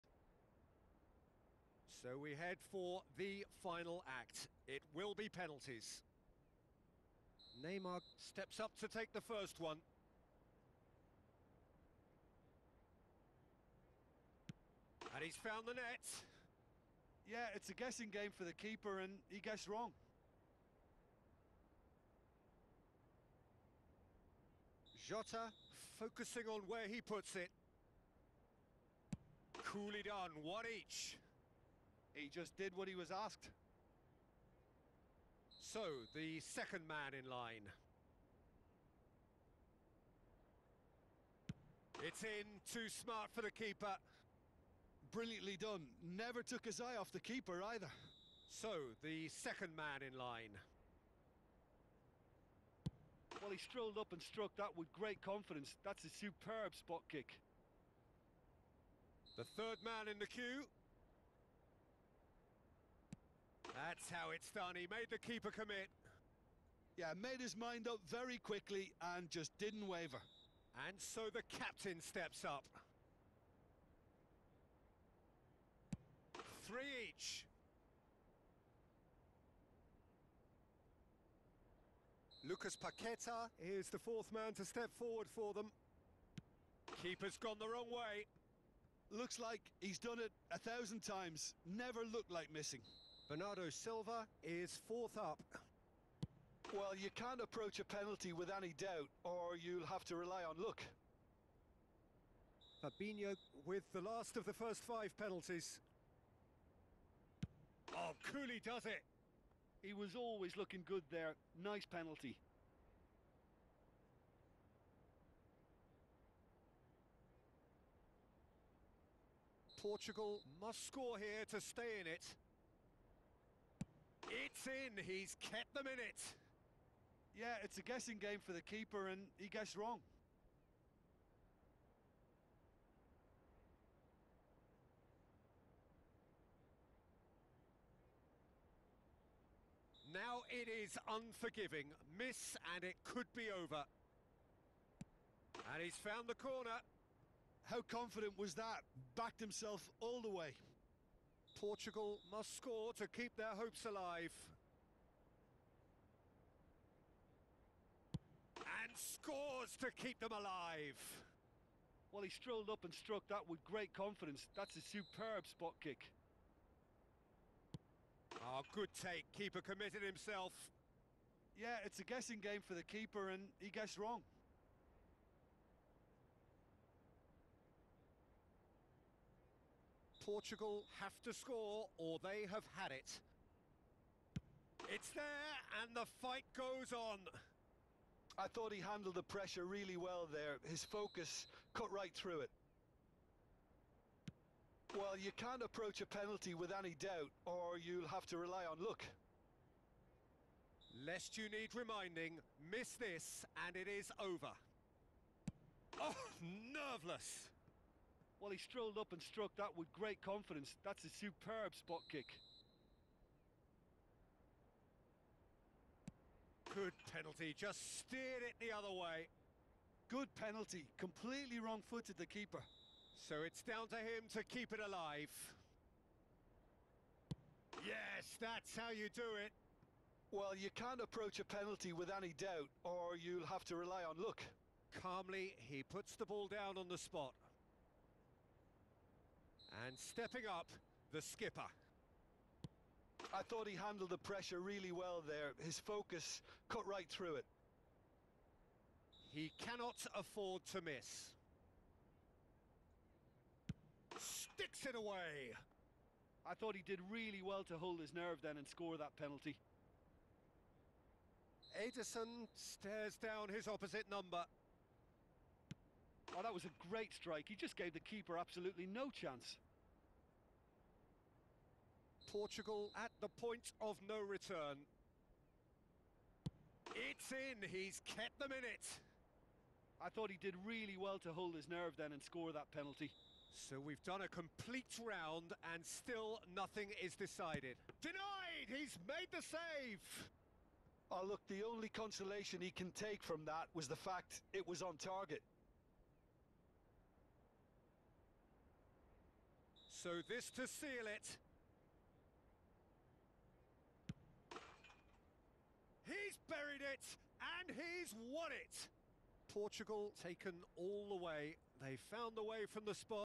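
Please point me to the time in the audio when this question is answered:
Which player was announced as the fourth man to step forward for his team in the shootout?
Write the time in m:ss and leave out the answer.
1:22.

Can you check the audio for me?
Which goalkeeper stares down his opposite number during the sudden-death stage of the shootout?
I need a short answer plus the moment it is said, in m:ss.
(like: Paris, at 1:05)
Ederson, at 4:21.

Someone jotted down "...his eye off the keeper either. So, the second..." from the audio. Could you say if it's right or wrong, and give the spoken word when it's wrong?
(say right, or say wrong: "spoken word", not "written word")
right.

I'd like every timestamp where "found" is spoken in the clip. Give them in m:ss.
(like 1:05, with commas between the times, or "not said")
0:15, 2:25, 5:12.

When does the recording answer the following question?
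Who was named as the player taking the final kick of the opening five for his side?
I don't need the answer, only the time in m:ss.
1:42.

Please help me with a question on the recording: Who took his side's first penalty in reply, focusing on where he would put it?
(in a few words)
Jota.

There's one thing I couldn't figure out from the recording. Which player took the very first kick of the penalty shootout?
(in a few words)
Neymar.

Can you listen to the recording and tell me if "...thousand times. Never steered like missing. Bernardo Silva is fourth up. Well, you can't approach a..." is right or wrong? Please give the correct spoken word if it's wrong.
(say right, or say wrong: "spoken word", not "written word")
wrong: "looked", not "steered".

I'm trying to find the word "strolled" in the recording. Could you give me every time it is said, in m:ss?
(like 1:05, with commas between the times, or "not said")
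0:53, 2:42, 3:28.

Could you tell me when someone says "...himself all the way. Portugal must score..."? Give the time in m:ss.
2:29.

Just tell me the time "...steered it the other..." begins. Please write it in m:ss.
3:37.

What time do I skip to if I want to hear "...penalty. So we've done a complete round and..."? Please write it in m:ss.
4:42.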